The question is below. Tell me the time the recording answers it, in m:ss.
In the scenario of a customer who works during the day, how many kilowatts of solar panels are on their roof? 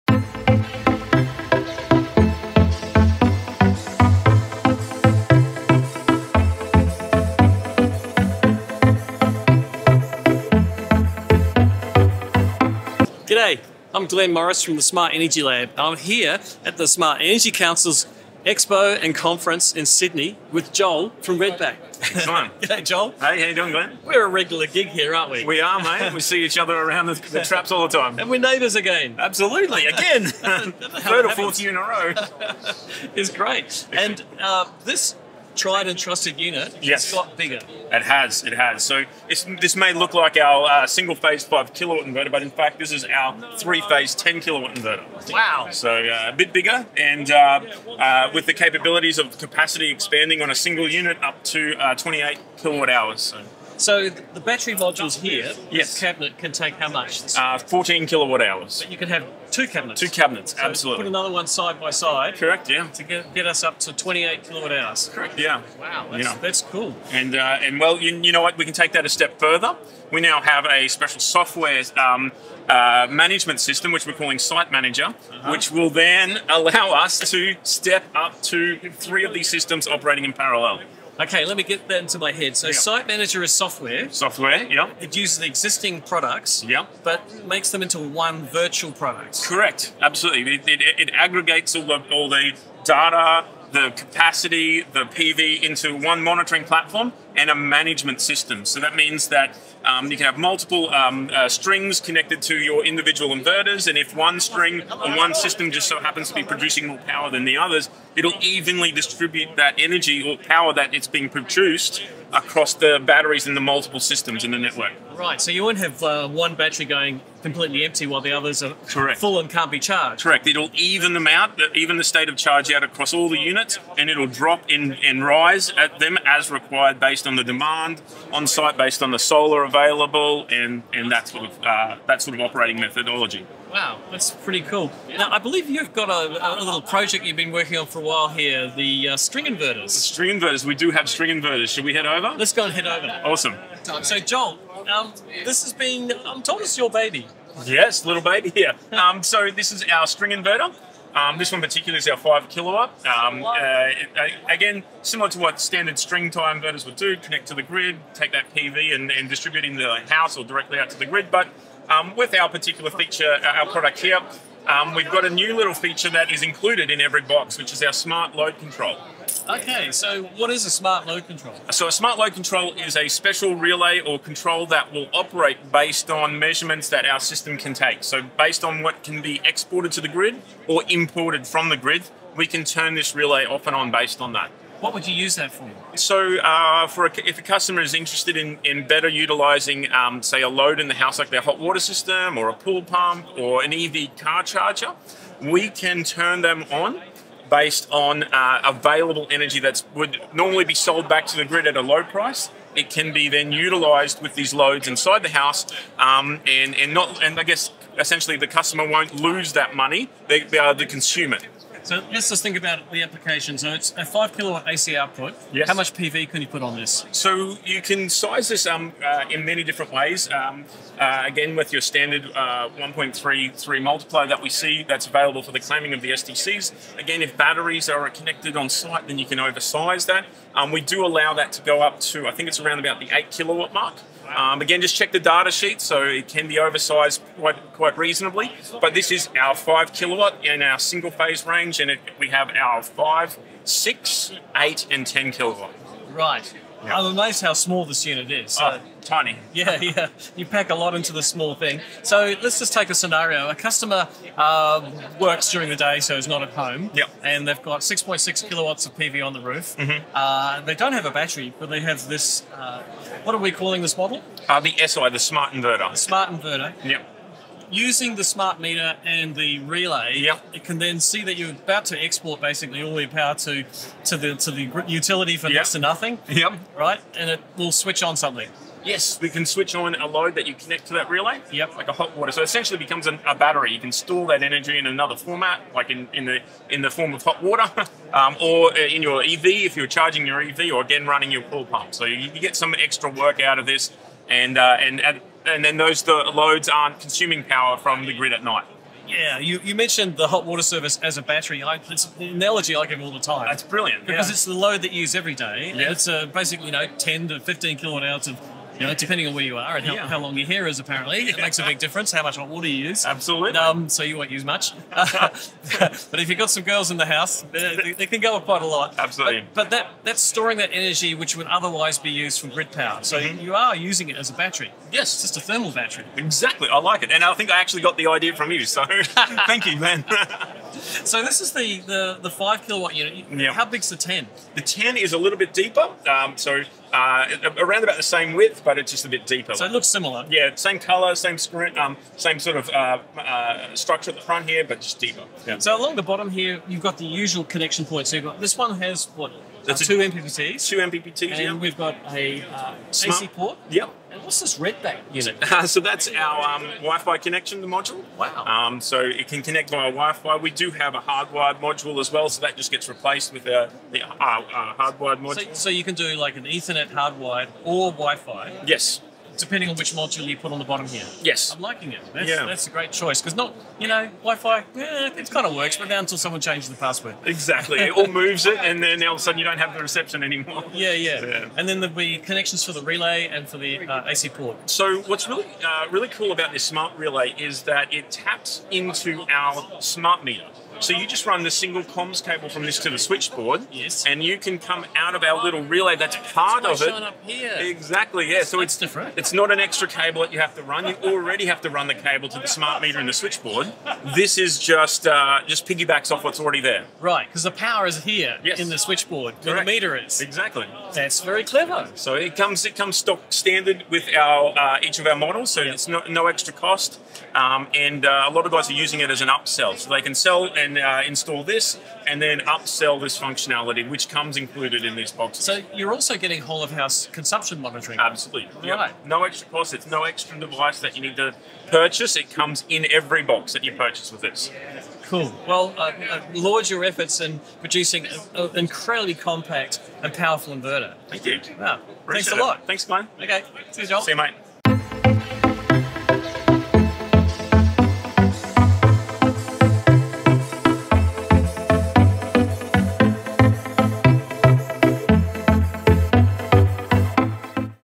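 4:17.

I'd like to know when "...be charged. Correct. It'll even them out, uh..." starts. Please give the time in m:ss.
1:59.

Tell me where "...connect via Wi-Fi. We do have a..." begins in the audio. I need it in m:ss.
5:59.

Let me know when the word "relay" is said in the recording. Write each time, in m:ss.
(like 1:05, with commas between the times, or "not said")
2:53, 3:03, 4:29, 4:41, 6:22, 6:26, 6:35.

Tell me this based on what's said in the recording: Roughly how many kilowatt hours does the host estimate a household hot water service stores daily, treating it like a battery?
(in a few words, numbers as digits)
10 to 15.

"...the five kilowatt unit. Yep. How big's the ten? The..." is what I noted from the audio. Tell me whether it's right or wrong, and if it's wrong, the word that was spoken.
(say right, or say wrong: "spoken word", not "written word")
right.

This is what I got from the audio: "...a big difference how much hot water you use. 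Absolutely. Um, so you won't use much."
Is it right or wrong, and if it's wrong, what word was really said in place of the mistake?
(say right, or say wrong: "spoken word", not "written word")
right.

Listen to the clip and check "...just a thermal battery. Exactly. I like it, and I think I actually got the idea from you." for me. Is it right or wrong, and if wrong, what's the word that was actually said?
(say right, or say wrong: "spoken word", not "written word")
right.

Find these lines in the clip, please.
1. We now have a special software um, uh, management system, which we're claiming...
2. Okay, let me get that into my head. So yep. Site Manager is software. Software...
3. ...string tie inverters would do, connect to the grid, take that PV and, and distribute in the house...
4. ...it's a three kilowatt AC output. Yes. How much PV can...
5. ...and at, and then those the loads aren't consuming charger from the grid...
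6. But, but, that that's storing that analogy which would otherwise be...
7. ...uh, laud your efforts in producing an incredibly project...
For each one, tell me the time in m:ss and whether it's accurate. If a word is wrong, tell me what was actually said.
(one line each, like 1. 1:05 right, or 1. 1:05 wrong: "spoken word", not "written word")
1. 1:10 wrong: "calling", not "claiming"
2. 1:21 right
3. 2:35 right
4. 3:33 wrong: "five", not "three"
5. 4:54 wrong: "power", not "charger"
6. 5:19 wrong: "energy", not "analogy"
7. 7:16 wrong: "compact", not "project".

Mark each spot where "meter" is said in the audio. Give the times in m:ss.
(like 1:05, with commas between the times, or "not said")
4:28, 6:30, 6:42, 6:49.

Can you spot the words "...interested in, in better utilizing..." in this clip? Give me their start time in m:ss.
3:07.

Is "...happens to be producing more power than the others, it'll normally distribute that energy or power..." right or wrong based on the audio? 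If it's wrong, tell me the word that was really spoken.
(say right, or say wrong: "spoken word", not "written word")
wrong: "evenly", not "normally".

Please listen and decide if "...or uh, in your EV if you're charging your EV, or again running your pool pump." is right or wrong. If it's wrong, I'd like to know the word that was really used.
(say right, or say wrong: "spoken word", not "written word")
right.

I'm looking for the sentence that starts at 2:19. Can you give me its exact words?
The string inverters, we do have string inverters.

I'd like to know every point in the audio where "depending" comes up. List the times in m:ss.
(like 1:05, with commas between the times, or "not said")
5:08, 6:09.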